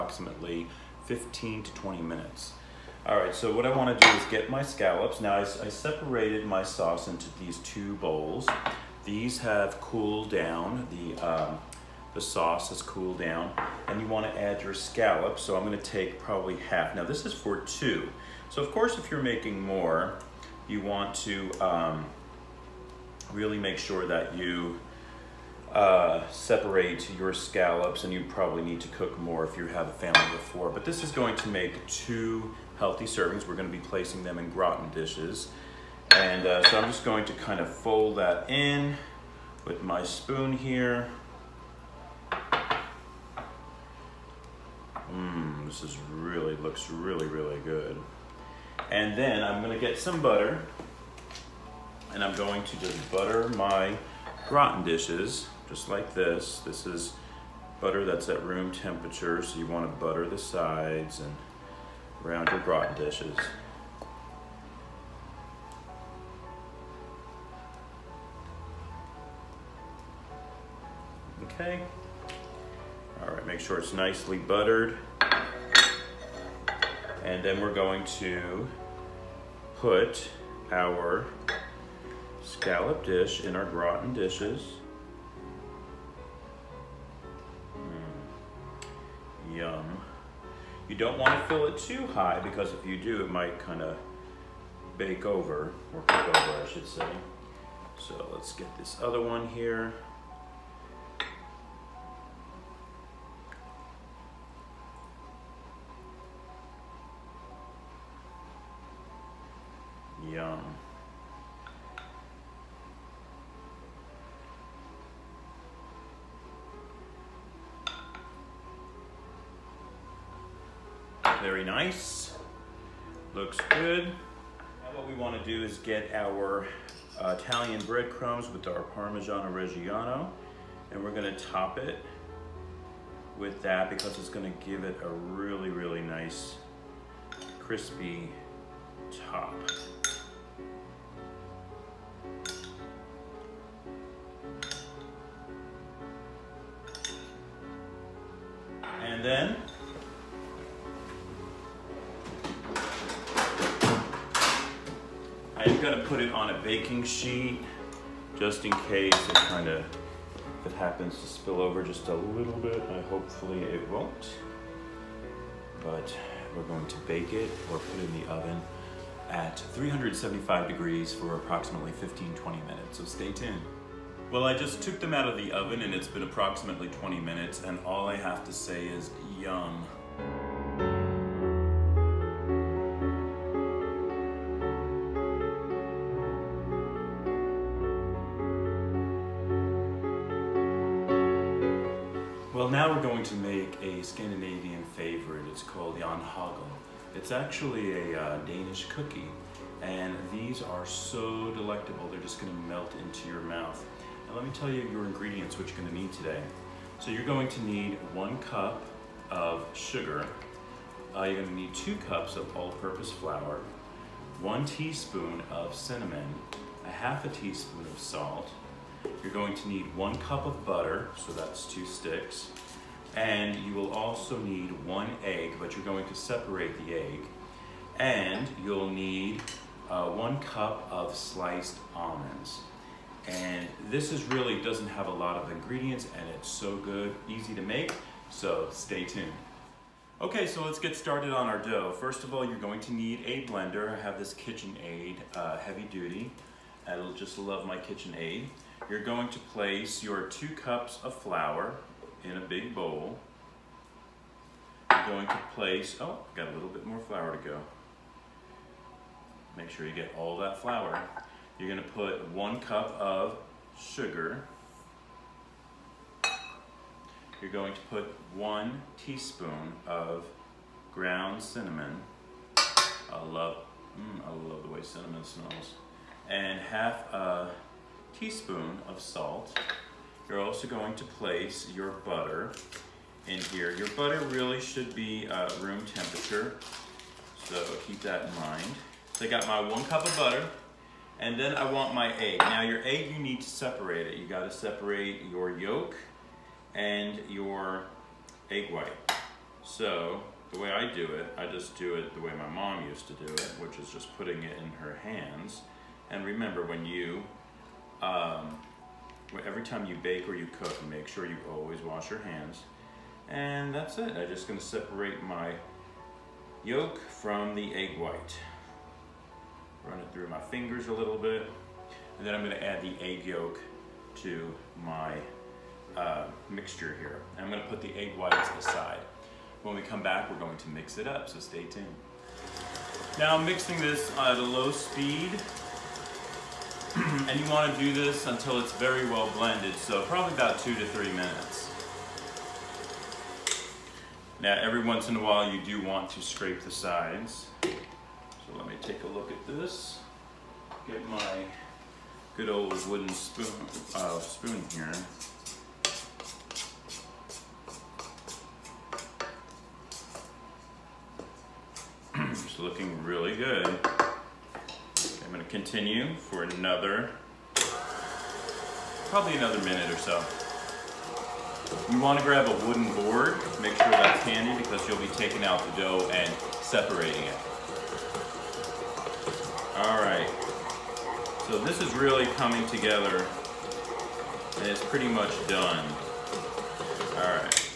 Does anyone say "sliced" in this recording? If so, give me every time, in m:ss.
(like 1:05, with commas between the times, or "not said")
3:51.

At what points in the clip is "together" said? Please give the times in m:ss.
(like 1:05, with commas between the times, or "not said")
6:22.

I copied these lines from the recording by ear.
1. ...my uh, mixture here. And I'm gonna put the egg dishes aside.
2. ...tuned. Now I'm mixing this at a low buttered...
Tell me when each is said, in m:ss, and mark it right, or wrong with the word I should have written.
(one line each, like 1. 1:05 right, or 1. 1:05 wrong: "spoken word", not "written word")
1. 5:24 wrong: "whites", not "dishes"
2. 5:31 wrong: "speed", not "buttered".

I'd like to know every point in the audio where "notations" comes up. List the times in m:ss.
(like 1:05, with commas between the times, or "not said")
not said.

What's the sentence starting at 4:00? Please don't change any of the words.
Okay, so let's get started on our dough.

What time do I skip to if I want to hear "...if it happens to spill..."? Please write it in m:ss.
2:40.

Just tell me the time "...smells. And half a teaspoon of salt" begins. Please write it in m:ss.
4:35.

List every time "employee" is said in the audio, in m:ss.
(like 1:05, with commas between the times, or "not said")
not said.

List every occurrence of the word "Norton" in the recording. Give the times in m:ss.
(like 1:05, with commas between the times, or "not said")
not said.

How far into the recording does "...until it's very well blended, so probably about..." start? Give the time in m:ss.
5:38.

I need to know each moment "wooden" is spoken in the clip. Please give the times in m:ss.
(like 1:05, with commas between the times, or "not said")
5:52, 6:12.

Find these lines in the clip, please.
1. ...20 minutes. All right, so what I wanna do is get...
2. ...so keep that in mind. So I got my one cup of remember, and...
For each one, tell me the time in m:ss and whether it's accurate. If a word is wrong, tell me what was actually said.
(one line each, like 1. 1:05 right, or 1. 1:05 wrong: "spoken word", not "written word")
1. 0:01 right
2. 4:47 wrong: "butter", not "remember".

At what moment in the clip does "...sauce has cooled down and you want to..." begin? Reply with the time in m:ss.
0:12.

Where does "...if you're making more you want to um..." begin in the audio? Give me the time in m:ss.
0:18.